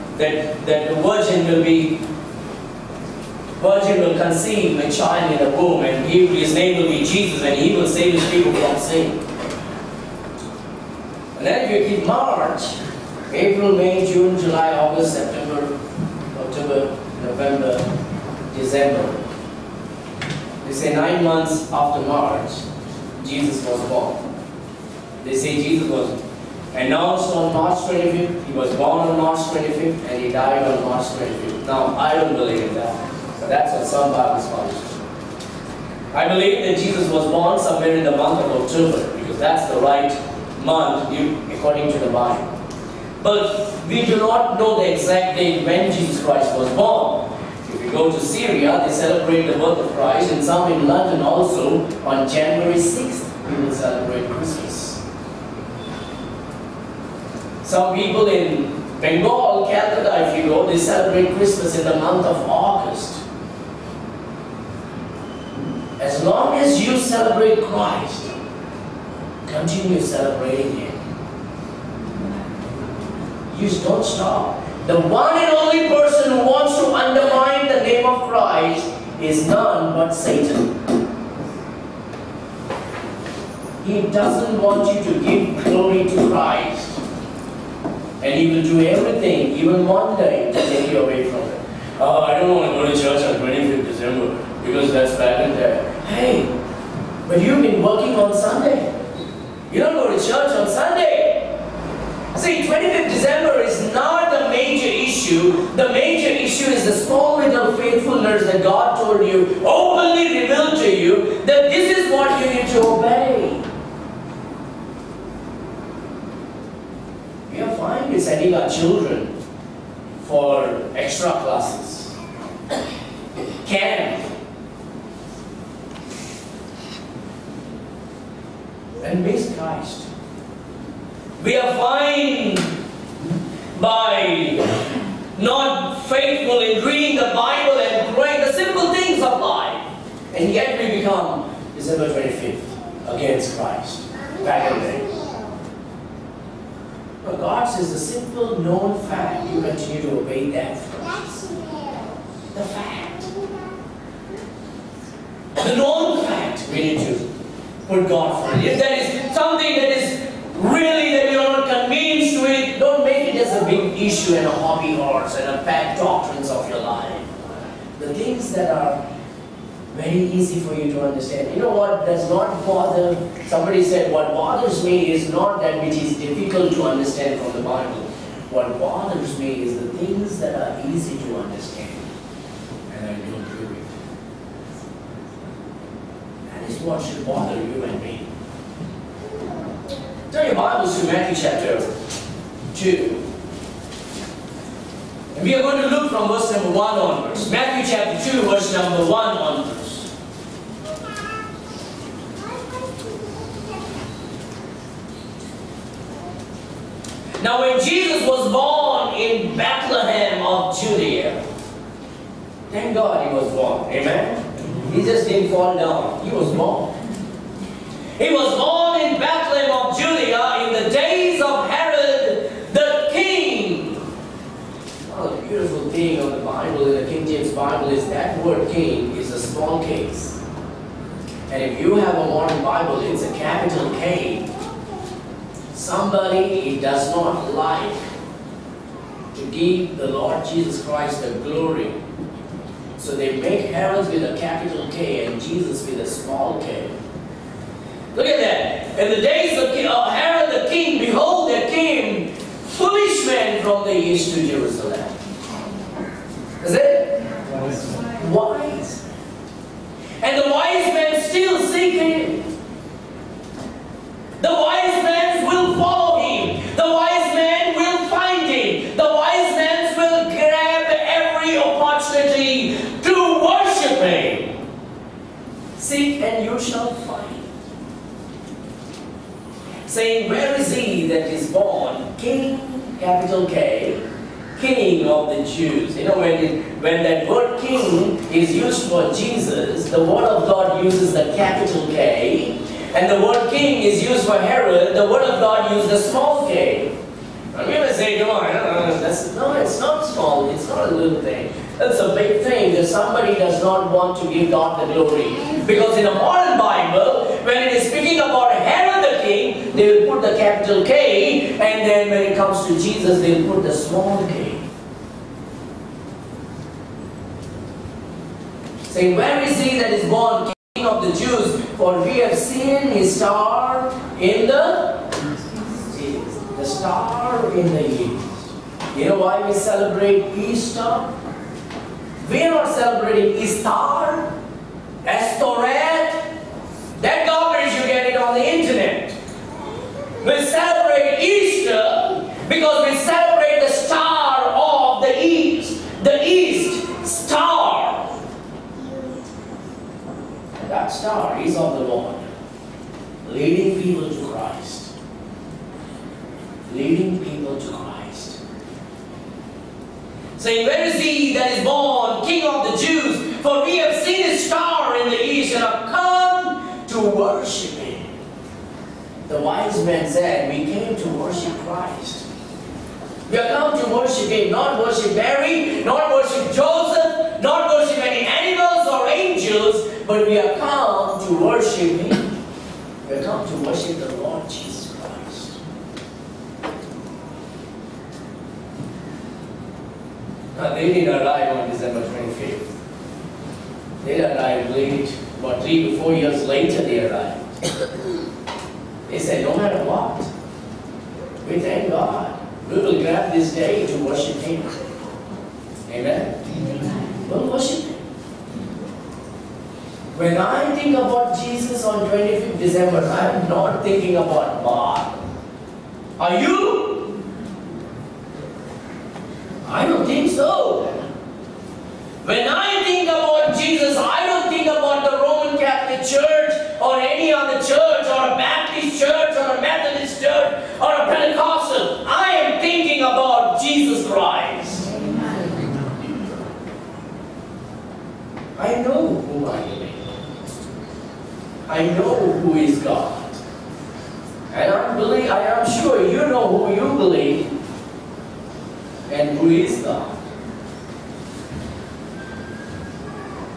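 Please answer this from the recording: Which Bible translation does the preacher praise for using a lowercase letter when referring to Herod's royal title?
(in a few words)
King James Bible.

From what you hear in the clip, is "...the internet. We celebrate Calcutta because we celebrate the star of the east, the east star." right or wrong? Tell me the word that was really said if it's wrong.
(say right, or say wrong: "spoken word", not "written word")
wrong: "Easter", not "Calcutta".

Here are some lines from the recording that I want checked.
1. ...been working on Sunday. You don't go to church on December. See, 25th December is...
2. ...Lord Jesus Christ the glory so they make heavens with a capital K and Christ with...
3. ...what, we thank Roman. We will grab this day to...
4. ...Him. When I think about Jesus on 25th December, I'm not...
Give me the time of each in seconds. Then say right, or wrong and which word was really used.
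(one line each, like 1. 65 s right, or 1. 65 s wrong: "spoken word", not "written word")
1. 97 s wrong: "Sunday", not "December"
2. 240 s wrong: "Jesus", not "Christ"
3. 399 s wrong: "God", not "Roman"
4. 407 s right.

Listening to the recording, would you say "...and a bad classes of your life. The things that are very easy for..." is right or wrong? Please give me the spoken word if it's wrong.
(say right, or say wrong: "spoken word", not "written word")
wrong: "doctrines", not "classes".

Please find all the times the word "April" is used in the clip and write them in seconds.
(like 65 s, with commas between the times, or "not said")
13 s.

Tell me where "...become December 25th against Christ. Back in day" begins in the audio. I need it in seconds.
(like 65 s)
141 s.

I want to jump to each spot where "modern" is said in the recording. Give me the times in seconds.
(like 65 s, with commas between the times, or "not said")
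232 s, 306 s.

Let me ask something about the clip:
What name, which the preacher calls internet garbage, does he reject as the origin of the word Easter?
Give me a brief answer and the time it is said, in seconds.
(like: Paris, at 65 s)
Estoret, at 335 s.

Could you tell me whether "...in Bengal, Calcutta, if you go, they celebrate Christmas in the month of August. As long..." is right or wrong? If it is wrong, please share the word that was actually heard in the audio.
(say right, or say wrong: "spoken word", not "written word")
right.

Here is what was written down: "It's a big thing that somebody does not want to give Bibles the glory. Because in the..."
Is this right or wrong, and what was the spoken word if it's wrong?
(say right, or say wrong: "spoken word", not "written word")
wrong: "God", not "Bibles".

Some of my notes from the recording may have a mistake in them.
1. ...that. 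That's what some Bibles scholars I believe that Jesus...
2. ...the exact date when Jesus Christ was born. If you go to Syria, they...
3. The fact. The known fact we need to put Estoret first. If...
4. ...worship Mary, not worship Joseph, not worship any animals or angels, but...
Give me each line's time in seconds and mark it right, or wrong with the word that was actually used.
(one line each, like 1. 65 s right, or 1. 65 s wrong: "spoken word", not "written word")
1. 32 s right
2. 44 s right
3. 152 s wrong: "God", not "Estoret"
4. 374 s right.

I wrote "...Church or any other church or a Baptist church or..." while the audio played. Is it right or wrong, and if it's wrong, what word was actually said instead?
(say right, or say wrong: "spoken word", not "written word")
right.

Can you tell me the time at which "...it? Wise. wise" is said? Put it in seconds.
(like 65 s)
256 s.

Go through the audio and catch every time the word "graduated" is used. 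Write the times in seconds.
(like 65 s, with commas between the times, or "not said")
not said.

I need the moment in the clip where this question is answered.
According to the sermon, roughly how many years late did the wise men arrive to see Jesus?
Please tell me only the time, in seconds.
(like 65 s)
395 s.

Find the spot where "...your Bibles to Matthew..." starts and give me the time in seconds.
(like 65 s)
190 s.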